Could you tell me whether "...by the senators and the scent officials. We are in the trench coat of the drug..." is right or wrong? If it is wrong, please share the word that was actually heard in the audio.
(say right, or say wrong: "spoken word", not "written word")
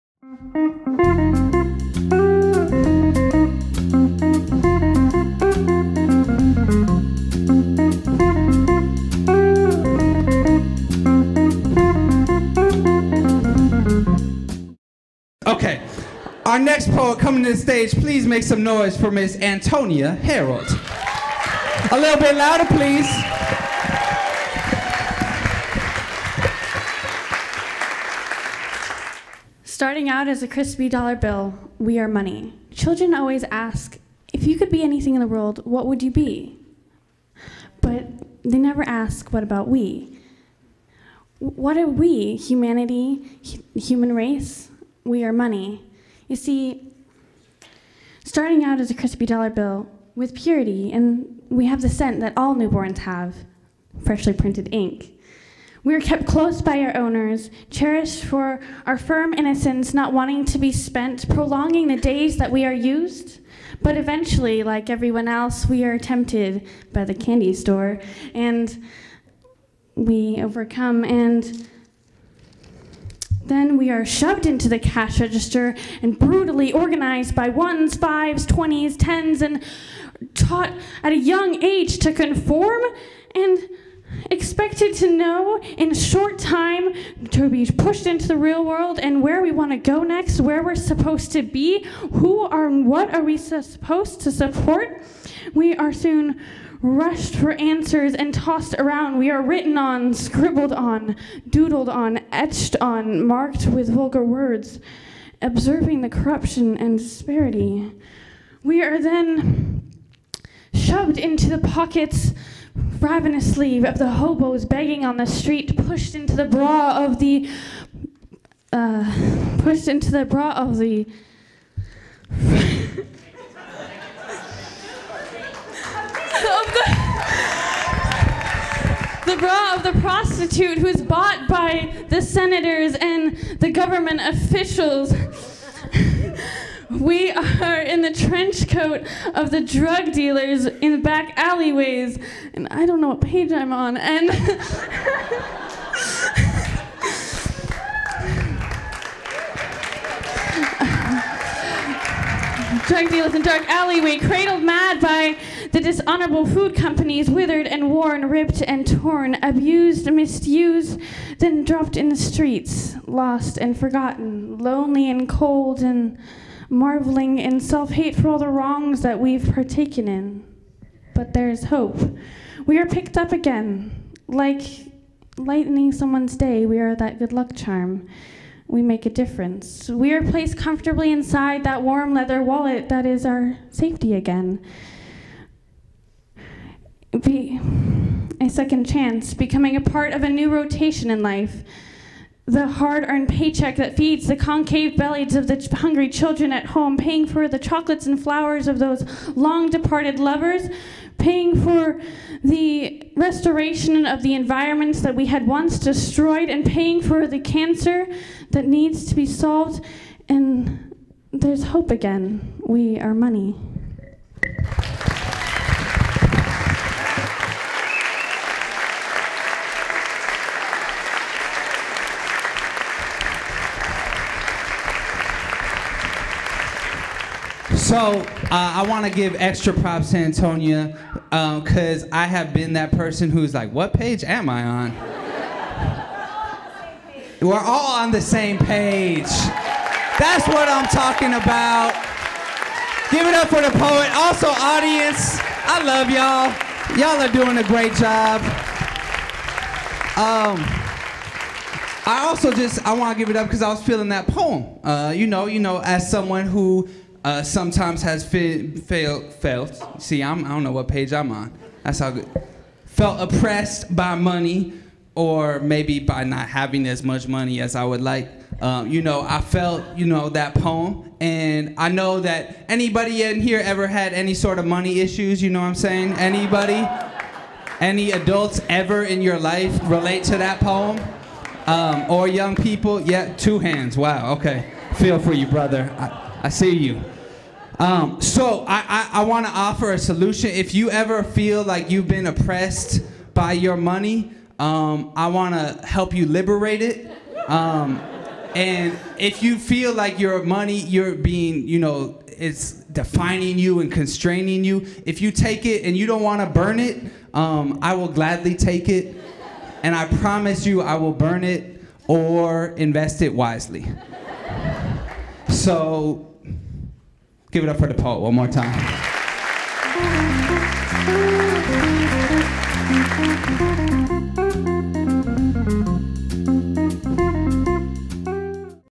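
wrong: "government", not "scent".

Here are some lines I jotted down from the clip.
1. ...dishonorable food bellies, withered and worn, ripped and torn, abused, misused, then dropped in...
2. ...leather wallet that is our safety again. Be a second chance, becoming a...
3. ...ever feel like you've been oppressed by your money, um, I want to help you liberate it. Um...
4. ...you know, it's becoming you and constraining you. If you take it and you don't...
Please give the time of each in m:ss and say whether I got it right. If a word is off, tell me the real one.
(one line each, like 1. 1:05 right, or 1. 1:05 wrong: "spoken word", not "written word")
1. 2:35 wrong: "companies", not "bellies"
2. 3:02 right
3. 4:50 right
4. 5:01 wrong: "defining", not "becoming".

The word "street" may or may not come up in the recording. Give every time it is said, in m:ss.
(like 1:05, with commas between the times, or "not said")
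1:55, 2:42.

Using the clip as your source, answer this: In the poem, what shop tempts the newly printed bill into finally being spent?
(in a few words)
the candy store.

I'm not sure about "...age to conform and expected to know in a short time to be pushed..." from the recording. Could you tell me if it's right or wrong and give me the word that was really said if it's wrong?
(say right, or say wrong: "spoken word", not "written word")
right.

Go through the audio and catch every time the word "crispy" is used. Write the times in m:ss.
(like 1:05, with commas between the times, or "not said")
0:30, 0:48.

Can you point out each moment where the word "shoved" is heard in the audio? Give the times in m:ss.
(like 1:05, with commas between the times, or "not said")
1:14, 1:50.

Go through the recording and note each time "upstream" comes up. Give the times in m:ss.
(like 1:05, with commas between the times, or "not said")
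not said.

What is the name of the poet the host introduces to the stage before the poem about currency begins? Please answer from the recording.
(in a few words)
Antonia Harold.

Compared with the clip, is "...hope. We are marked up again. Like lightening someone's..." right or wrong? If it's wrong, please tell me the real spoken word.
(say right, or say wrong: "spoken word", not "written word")
wrong: "picked", not "marked".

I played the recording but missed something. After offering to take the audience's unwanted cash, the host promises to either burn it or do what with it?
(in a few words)
invest it wisely.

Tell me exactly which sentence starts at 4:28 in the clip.
Um, you know, I felt, you know, that poem.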